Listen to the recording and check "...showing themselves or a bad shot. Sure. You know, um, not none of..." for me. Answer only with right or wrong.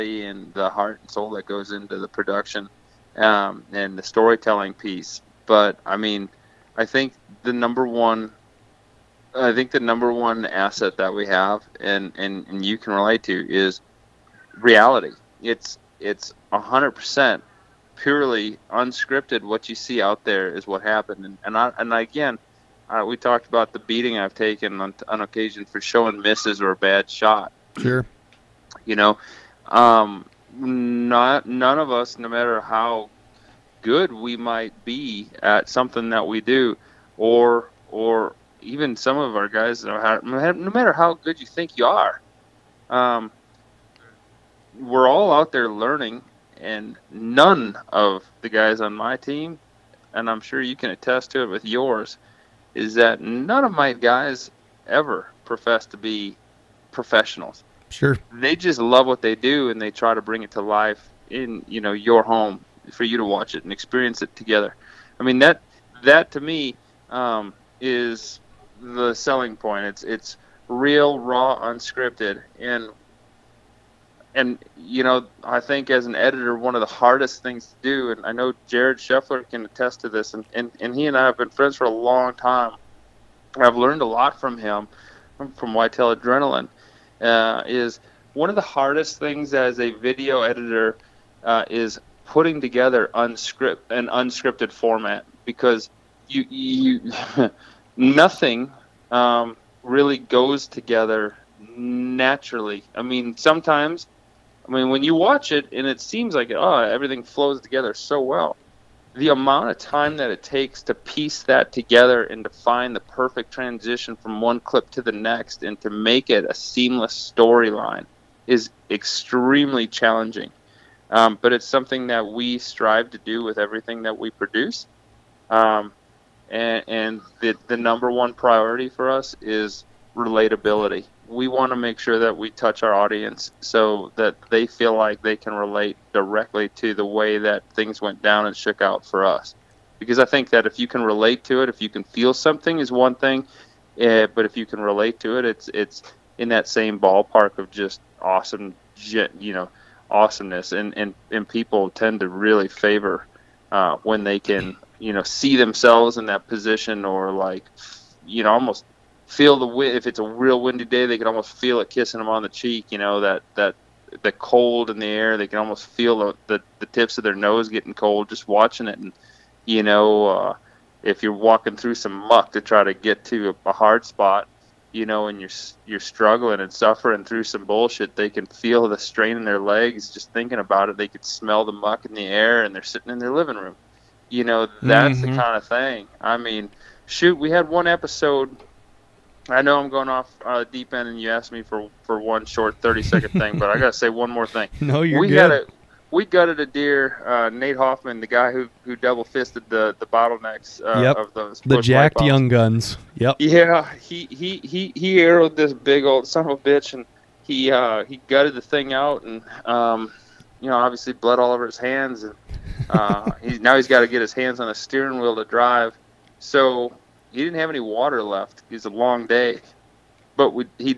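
wrong.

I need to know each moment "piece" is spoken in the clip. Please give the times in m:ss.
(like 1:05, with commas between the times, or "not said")
0:04, 1:50.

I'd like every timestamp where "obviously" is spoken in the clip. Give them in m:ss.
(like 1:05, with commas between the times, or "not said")
3:30.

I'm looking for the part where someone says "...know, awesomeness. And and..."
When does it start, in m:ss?
2:29.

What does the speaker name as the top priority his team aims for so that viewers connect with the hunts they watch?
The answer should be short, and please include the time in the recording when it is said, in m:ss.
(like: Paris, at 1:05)
relatability, at 2:10.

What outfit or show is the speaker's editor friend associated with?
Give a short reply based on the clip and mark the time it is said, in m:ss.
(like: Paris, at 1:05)
Whitetail Adrenaline, at 1:25.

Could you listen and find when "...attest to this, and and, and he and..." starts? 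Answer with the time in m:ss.
1:19.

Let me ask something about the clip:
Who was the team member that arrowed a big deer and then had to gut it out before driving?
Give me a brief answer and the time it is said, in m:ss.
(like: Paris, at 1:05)
Nate Hoffman, at 3:17.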